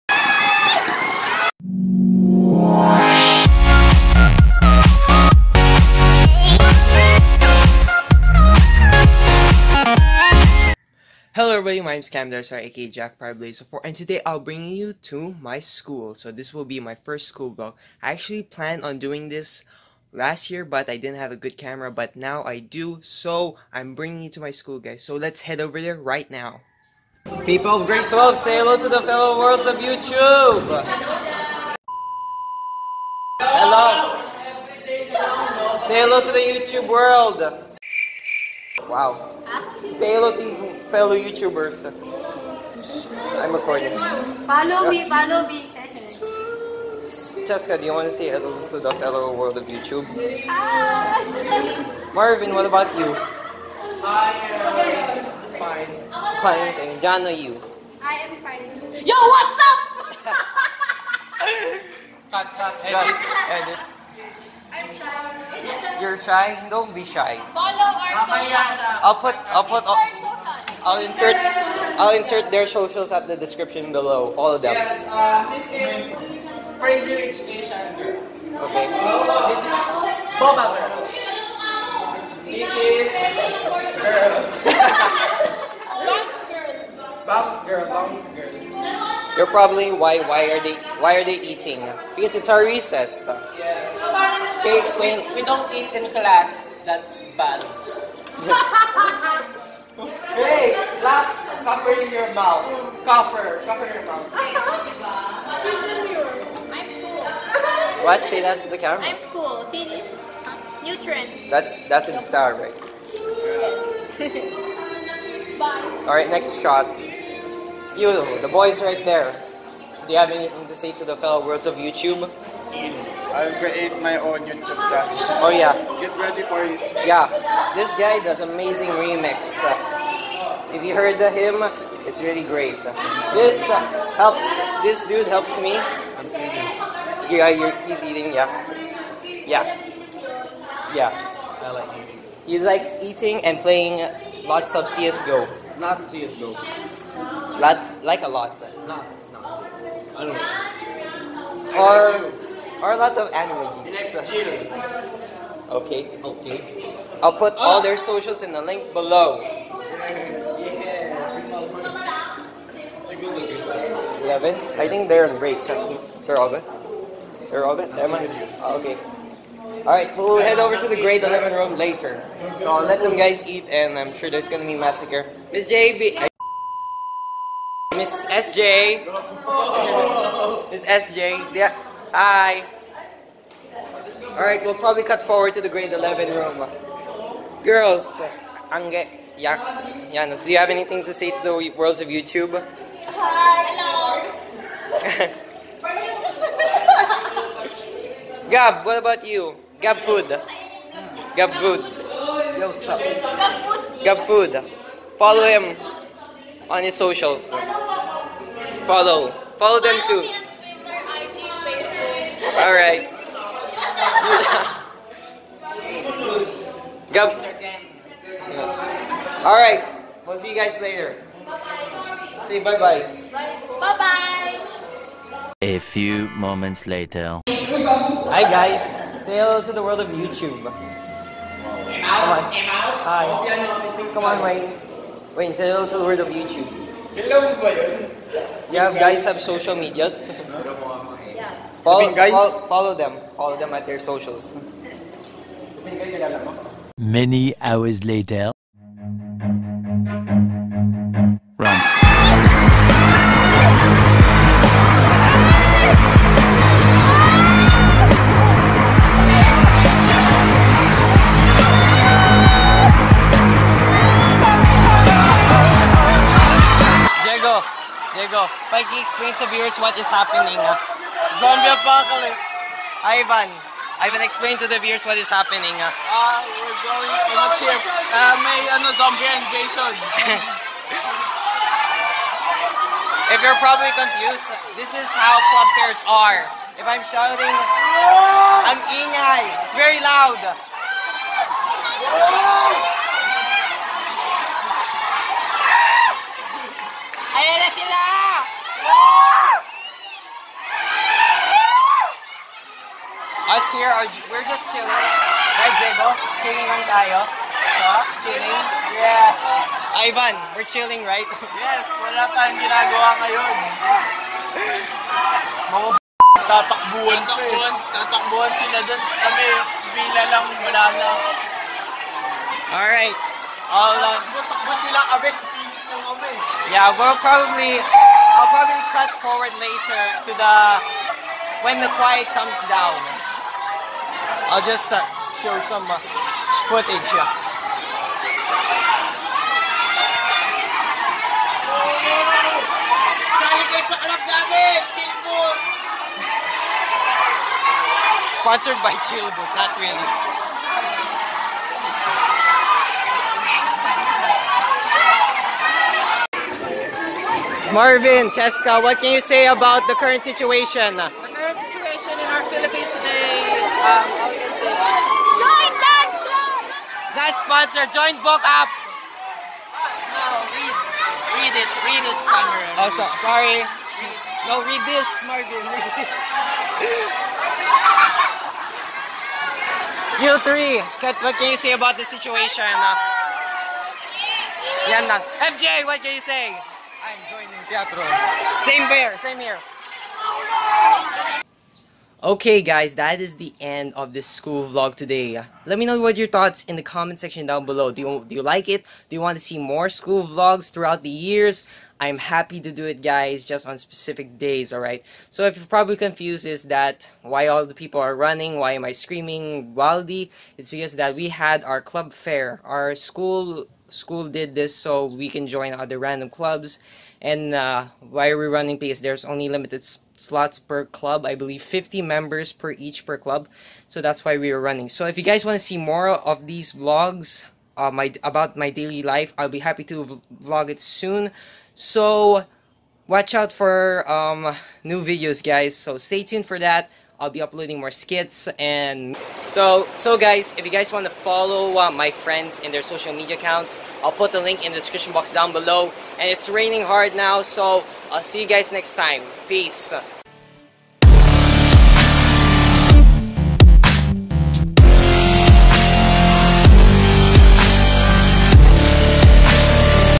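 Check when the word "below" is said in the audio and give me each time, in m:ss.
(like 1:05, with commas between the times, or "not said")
1:13, 2:38, 6:37, 7:25.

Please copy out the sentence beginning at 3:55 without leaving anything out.
Wayne, say hello to the world of YouTube.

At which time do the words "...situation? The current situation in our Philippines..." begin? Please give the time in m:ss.
6:00.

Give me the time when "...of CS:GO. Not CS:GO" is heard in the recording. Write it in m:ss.
2:24.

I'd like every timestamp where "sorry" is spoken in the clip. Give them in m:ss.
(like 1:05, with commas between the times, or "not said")
6:13.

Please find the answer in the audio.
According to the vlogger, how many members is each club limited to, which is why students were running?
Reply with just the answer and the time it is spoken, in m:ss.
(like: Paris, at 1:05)
50 members, at 7:01.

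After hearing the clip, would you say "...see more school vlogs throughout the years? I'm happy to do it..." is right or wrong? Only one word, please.
right.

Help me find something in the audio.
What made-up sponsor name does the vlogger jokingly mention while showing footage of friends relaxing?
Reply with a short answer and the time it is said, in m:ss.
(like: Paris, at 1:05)
Chillboot, at 5:49.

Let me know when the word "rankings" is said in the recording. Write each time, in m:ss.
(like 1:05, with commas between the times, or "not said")
not said.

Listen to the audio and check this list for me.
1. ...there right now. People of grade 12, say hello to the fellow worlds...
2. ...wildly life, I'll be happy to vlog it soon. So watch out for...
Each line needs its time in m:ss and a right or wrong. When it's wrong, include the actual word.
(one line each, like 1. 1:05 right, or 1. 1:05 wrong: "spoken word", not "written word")
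1. 0:25 right
2. 7:08 wrong: "daily", not "wildly".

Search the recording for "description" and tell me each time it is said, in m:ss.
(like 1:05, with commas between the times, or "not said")
1:13, 7:24.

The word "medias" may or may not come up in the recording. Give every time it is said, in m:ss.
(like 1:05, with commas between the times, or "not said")
3:59, 7:23.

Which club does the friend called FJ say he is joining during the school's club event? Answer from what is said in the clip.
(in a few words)
Teatro.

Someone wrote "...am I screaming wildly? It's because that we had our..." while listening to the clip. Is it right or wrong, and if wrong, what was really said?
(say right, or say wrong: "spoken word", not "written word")
right.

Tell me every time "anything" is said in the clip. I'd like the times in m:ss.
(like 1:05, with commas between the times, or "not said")
2:00, 3:10.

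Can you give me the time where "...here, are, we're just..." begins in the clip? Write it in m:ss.
5:03.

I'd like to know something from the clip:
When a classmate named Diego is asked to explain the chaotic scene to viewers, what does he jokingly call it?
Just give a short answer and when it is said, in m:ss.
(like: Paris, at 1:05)
Zombie apocalypse, at 4:31.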